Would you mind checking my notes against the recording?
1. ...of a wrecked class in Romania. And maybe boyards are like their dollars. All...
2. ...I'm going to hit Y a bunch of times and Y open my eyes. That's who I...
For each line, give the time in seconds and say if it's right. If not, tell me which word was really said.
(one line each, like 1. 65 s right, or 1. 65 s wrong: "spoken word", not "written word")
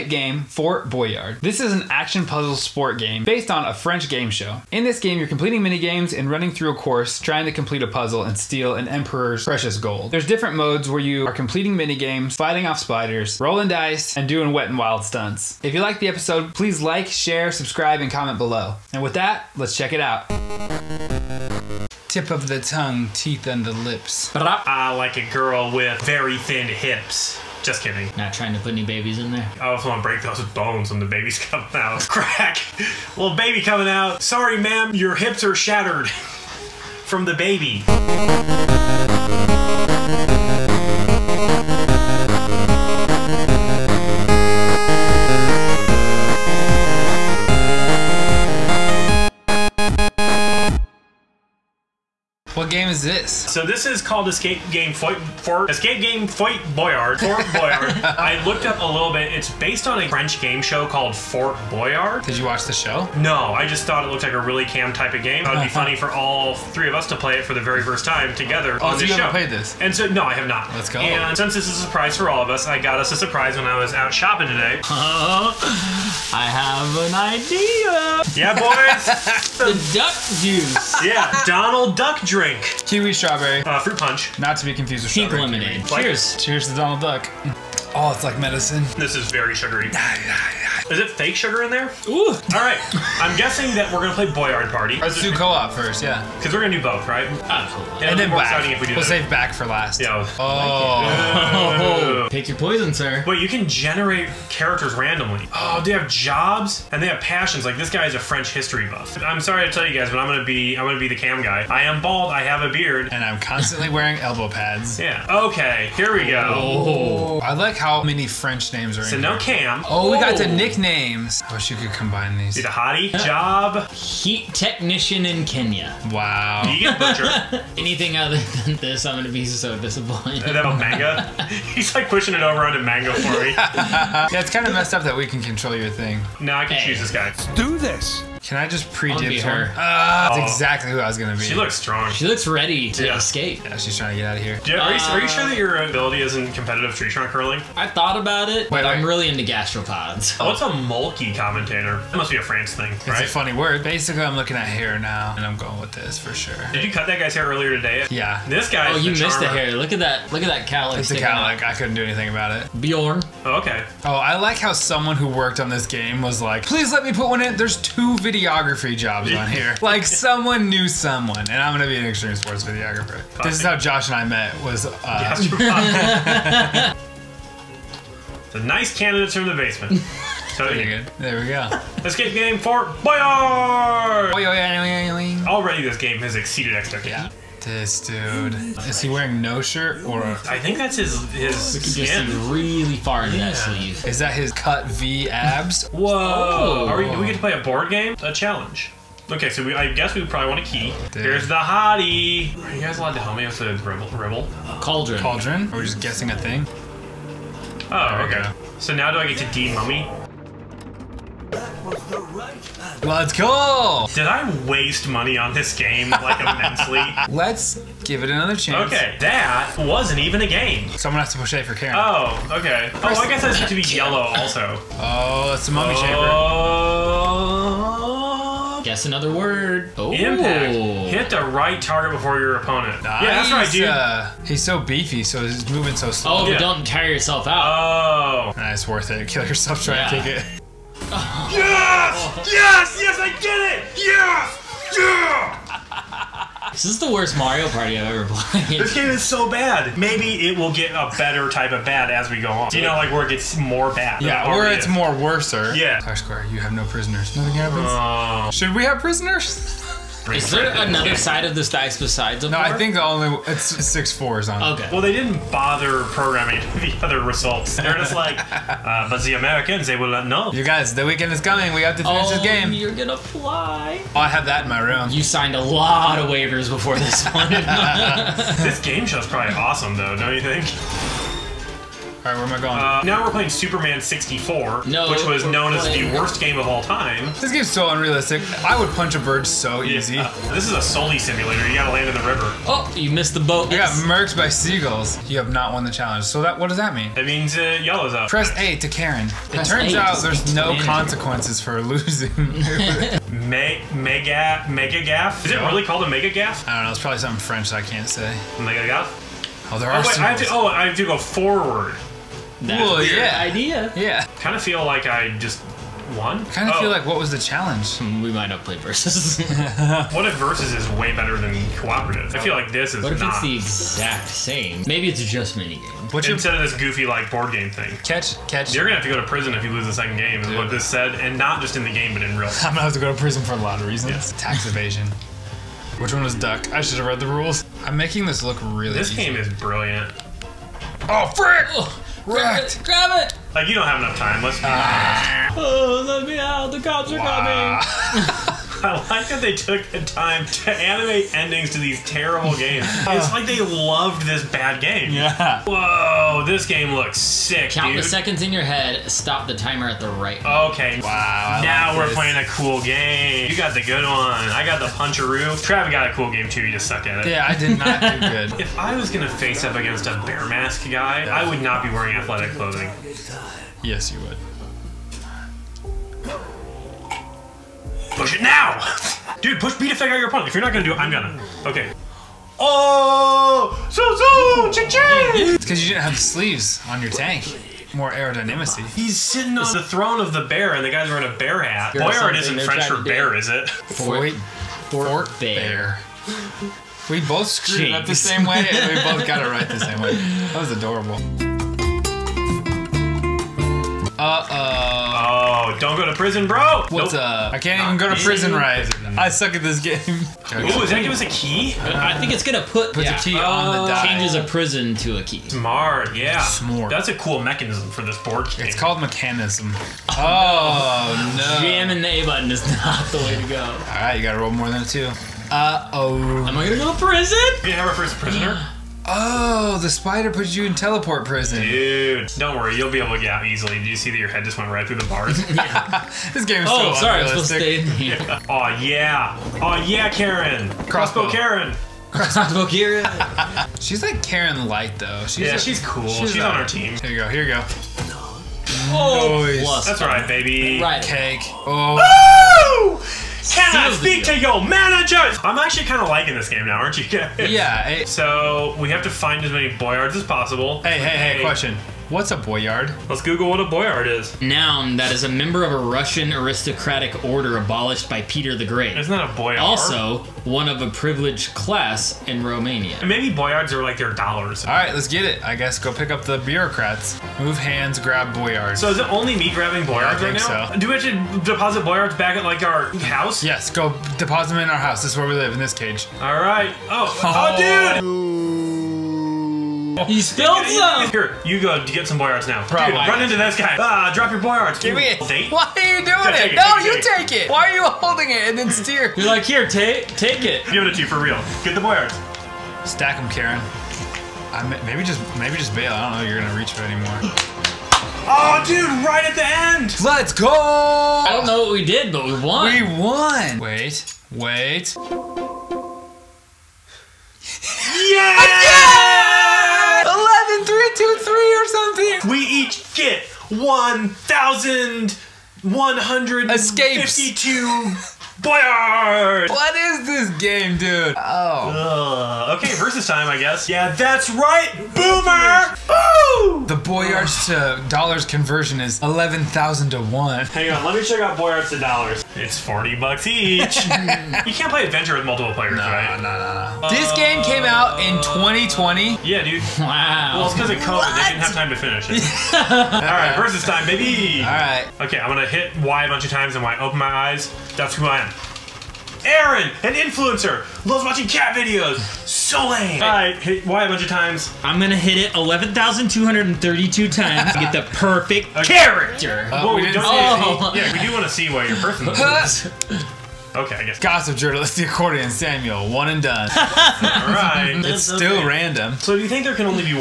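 1. 470 s wrong: "privileged", not "wrecked"
2. 555 s right.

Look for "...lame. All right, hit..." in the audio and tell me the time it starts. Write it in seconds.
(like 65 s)
562 s.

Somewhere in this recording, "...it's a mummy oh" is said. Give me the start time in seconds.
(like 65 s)
225 s.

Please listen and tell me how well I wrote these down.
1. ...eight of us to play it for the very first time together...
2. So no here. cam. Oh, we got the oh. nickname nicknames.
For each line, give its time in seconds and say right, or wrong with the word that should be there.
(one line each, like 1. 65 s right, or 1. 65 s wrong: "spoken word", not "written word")
1. 66 s wrong: "three", not "eight"
2. 119 s right.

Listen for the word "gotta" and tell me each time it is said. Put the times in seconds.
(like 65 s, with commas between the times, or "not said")
291 s, 424 s.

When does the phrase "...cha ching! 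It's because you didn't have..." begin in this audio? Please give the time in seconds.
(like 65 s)
384 s.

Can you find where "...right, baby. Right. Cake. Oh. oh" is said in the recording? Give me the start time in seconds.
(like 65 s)
450 s.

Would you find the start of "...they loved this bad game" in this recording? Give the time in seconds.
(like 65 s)
353 s.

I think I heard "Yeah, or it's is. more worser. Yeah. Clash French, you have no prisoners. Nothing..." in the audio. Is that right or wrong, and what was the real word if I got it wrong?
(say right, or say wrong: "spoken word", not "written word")
wrong: "Square", not "French".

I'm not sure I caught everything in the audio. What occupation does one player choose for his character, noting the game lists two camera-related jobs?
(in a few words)
extreme sports videographer.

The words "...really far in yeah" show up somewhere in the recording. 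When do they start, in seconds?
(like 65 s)
192 s.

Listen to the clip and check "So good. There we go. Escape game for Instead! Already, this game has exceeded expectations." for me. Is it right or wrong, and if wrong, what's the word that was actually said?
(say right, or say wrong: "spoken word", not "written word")
wrong: "Boyard", not "Instead".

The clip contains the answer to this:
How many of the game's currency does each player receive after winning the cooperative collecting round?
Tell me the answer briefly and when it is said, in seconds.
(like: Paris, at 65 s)
1,152, at 523 s.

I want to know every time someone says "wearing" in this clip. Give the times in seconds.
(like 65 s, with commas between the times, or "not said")
113 s, 189 s, 371 s, 391 s.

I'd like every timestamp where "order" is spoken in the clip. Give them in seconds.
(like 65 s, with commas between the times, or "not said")
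467 s.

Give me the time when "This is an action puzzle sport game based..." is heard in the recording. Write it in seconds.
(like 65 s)
1 s.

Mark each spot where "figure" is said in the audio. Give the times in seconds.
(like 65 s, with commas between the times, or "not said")
379 s.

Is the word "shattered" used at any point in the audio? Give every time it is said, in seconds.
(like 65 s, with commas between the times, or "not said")
35 s.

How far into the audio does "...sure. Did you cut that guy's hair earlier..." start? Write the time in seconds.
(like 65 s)
156 s.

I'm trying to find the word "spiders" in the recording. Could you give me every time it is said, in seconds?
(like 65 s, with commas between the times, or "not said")
12 s, 429 s.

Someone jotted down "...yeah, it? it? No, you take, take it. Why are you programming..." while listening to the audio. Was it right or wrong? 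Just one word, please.
wrong.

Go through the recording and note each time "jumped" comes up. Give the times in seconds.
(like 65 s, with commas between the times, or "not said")
not said.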